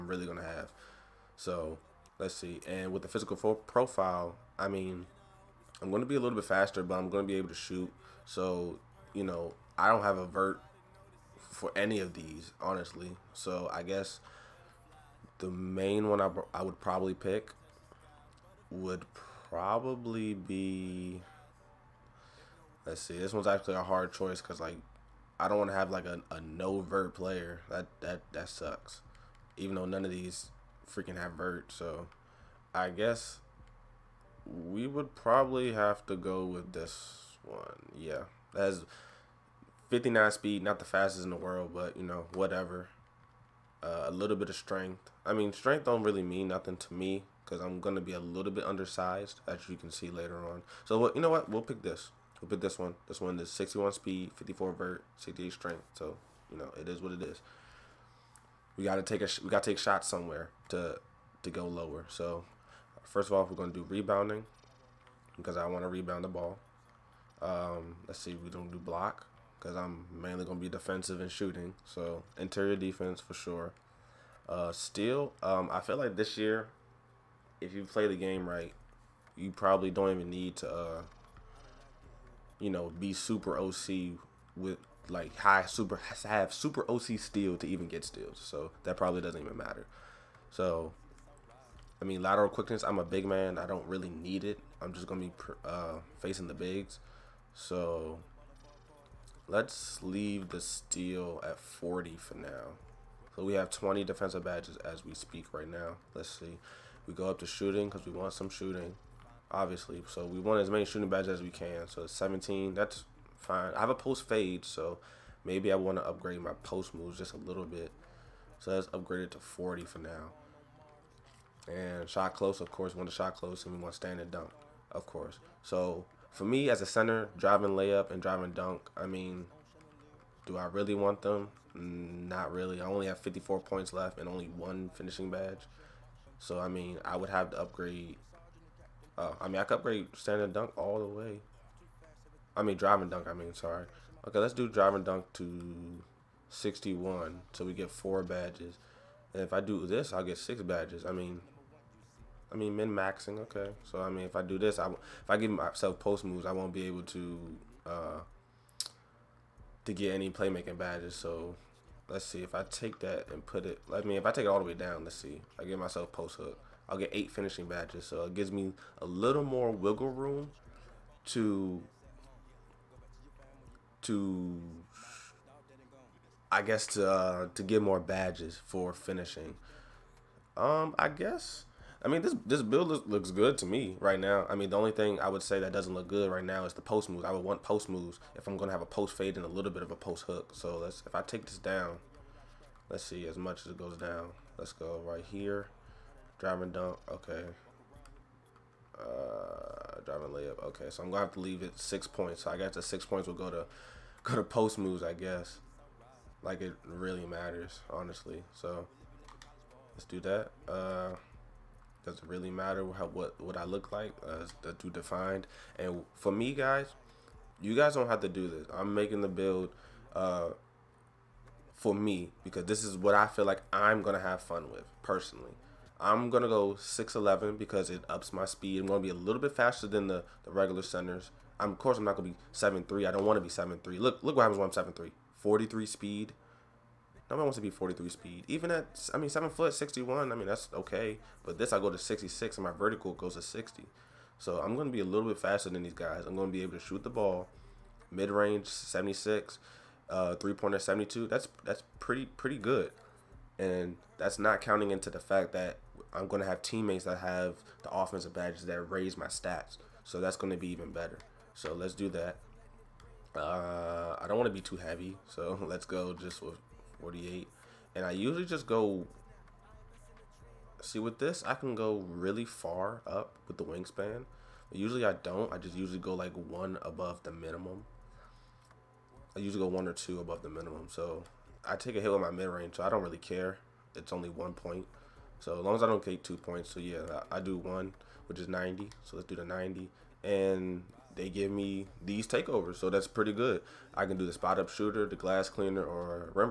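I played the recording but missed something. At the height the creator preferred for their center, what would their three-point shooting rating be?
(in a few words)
72.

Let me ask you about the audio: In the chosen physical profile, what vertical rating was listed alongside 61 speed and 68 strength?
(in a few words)
54.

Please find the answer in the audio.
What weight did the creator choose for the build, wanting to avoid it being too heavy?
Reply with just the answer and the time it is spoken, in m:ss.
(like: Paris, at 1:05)
48, at 4:27.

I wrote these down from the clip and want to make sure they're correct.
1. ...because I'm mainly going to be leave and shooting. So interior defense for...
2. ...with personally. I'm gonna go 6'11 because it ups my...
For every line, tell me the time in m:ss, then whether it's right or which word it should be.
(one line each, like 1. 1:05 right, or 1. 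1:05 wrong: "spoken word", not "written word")
1. 1:09 wrong: "defensive", not "leave"
2. 3:44 right.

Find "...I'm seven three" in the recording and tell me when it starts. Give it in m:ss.
3:54.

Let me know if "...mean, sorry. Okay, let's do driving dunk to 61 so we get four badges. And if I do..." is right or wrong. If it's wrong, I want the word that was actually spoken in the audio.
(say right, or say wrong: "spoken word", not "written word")
right.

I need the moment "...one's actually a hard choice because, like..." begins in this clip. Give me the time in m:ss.
0:23.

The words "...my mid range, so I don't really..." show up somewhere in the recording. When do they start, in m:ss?
4:42.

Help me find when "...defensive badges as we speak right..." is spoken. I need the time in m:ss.
1:44.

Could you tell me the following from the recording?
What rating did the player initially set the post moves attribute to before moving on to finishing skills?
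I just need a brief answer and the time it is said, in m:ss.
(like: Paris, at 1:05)
40, at 1:58.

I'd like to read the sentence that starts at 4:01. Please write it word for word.
But this, I go to 66, and my vertical goes to 60.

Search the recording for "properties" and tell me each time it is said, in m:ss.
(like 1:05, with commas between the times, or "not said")
not said.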